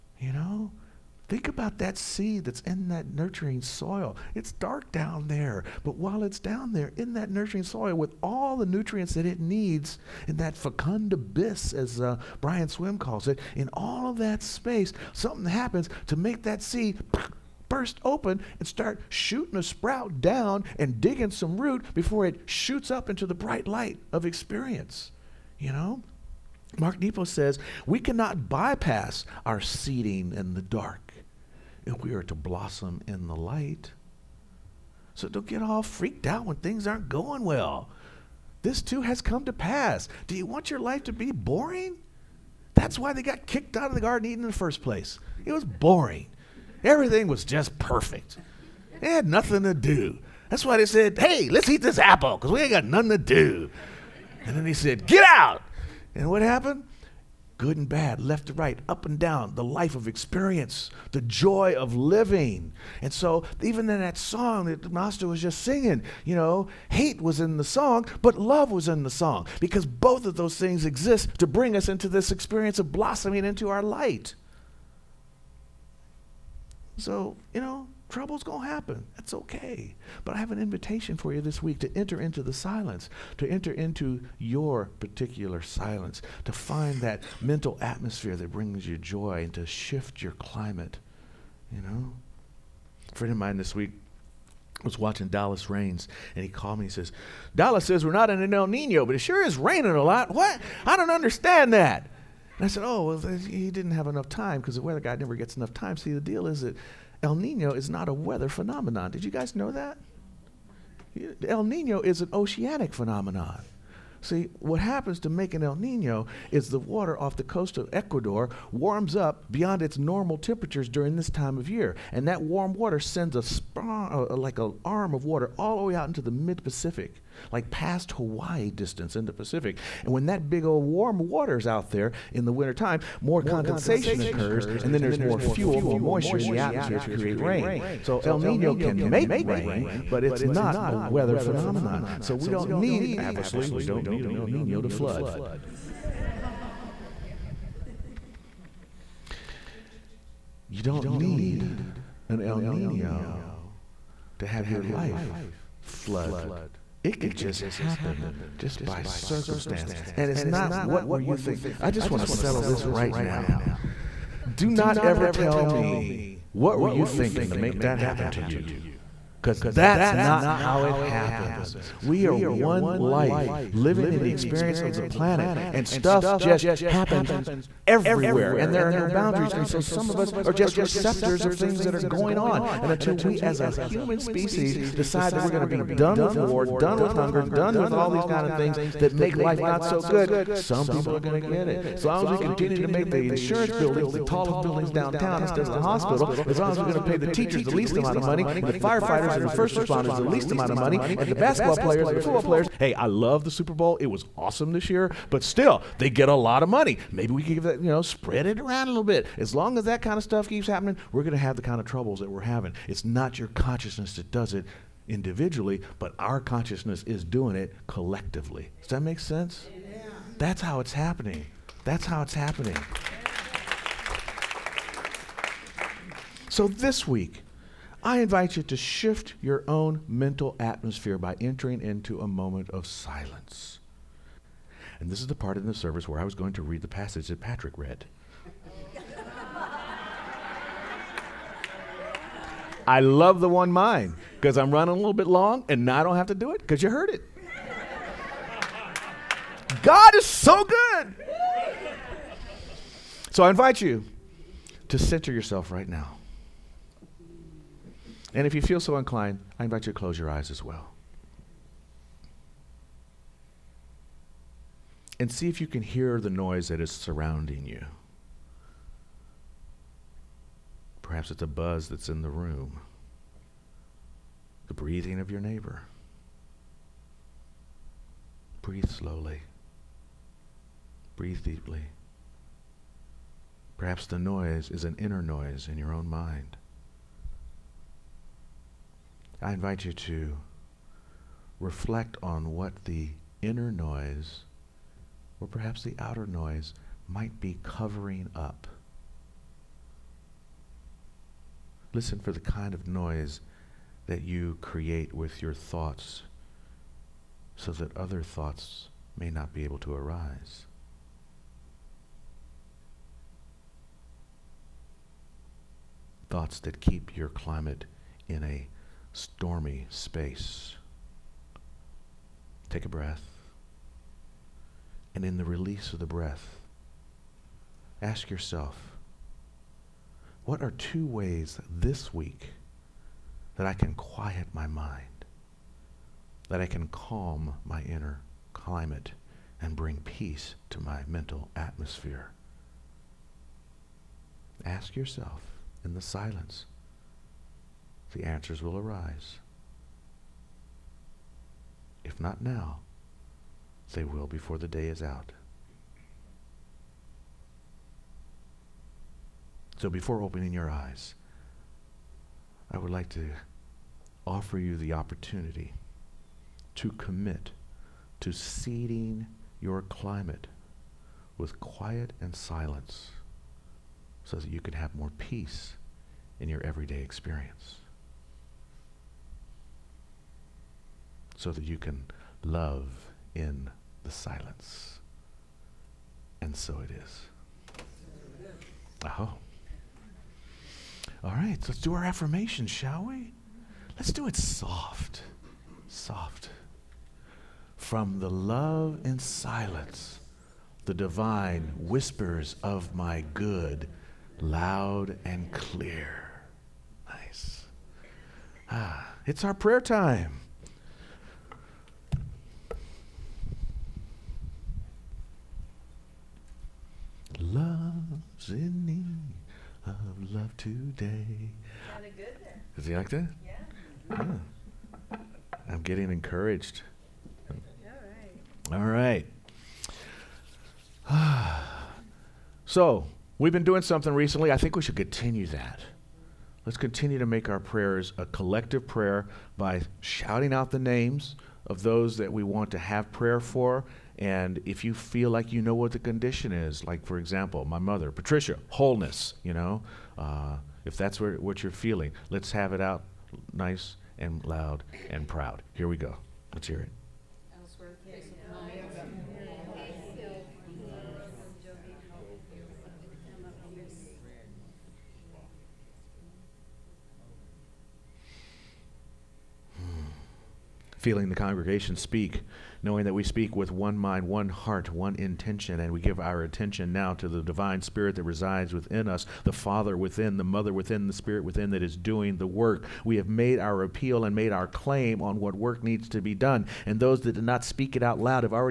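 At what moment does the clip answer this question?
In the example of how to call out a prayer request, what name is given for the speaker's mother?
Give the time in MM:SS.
07:28.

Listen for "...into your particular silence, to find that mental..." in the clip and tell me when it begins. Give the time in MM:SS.
01:23.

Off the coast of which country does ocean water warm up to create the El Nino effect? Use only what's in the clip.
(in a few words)
Ecuador.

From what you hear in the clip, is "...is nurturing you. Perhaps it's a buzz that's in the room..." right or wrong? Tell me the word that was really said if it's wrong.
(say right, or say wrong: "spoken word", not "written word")
wrong: "surrounding", not "nurturing".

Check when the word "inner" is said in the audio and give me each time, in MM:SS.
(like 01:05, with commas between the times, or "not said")
04:44, 04:53, 05:37.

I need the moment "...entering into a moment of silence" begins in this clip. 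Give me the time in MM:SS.
03:51.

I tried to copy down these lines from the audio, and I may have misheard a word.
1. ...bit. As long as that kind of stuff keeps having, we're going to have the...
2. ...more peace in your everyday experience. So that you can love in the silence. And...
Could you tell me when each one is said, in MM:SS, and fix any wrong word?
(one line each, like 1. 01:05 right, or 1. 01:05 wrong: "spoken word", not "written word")
1. 03:29 wrong: "happening", not "having"
2. 06:14 right.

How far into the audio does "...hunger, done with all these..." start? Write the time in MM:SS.
03:07.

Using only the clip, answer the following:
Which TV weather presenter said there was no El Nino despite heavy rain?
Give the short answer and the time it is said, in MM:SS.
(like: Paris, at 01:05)
Dallas Raines, at 01:35.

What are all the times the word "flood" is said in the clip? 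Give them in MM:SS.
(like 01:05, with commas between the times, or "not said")
02:24, 02:35.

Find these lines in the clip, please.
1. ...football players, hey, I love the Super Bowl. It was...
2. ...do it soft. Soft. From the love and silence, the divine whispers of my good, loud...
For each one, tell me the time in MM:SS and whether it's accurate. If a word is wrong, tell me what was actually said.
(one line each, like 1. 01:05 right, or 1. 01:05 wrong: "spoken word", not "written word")
1. 03:22 right
2. 06:34 right.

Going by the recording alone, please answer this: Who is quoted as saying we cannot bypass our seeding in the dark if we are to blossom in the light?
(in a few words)
Mark Nepo.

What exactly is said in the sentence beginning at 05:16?
Thoughts that keep your climate in a stormy space.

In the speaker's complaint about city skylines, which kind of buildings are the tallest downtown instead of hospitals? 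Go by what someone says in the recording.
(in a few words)
Insurance buildings.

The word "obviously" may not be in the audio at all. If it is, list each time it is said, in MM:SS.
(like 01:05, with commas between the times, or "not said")
02:23.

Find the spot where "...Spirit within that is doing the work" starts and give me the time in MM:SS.
08:01.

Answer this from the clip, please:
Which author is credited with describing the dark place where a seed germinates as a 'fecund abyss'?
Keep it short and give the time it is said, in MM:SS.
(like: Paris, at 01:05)
Brian Swim, at 00:12.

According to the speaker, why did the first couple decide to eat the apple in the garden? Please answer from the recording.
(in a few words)
It was boring.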